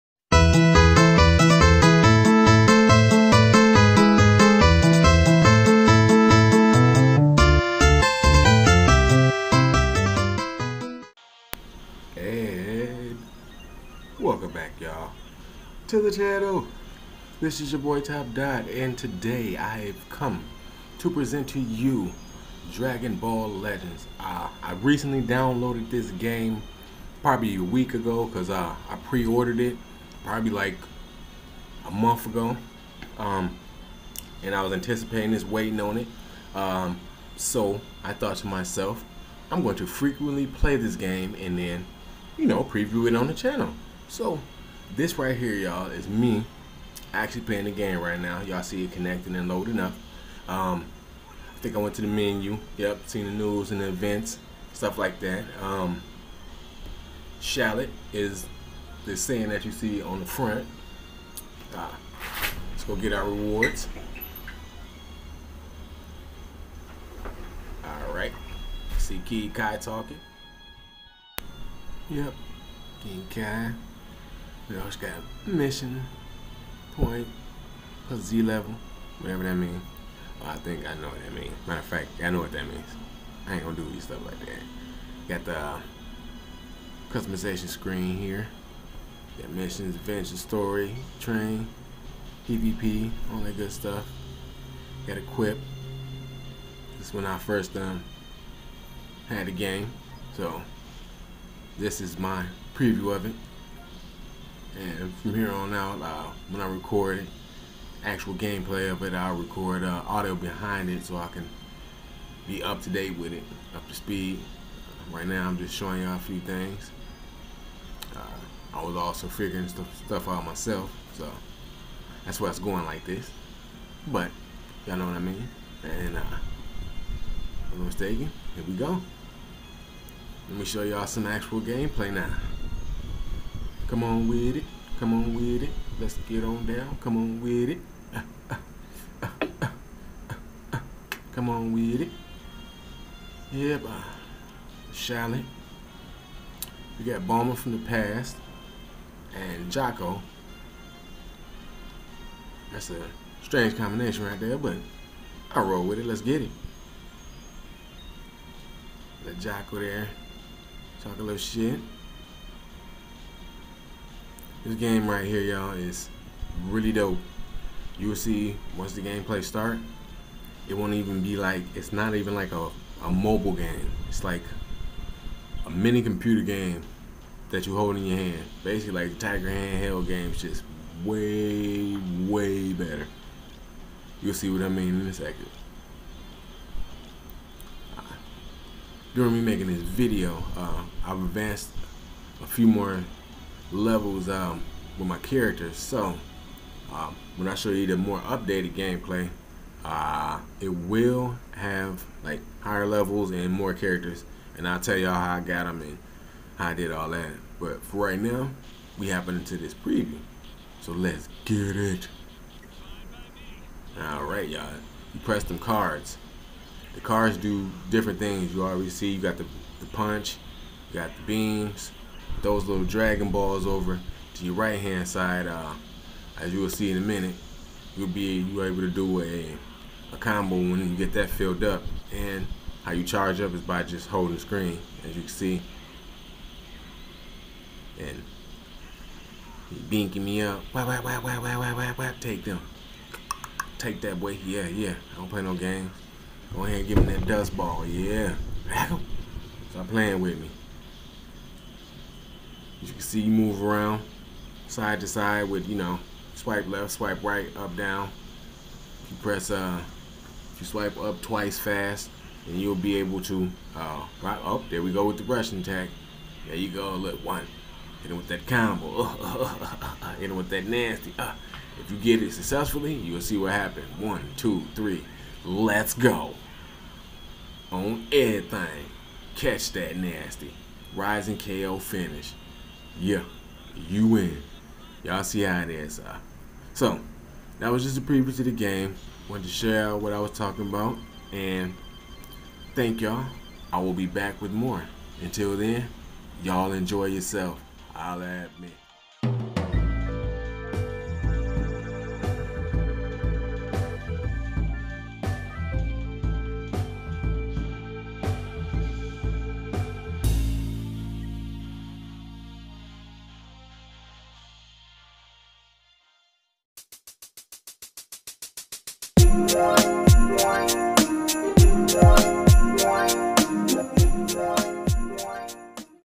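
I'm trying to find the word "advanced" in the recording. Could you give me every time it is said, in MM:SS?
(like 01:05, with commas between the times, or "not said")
03:11.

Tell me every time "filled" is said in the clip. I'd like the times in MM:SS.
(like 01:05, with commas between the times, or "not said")
03:51.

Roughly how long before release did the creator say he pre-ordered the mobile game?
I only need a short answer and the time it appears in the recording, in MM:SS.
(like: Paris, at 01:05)
a month ago, at 00:30.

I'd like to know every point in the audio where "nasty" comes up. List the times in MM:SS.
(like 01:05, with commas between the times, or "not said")
04:30, 04:39.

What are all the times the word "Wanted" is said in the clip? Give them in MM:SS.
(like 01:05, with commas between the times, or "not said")
04:49.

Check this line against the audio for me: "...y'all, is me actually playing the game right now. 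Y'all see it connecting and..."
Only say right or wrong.
right.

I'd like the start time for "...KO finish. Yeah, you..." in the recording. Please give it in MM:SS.
04:41.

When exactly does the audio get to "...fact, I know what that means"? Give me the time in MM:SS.
01:21.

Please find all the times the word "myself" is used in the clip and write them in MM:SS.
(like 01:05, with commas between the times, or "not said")
00:38, 02:00.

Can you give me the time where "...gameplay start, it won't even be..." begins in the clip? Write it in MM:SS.
02:49.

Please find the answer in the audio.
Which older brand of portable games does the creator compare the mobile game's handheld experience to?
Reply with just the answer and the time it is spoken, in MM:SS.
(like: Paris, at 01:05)
Tiger, at 02:59.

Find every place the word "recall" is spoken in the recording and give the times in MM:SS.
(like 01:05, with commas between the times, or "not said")
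not said.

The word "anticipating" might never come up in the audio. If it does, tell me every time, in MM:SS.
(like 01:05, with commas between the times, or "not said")
00:34.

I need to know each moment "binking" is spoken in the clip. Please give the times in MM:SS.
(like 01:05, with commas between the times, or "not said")
03:59.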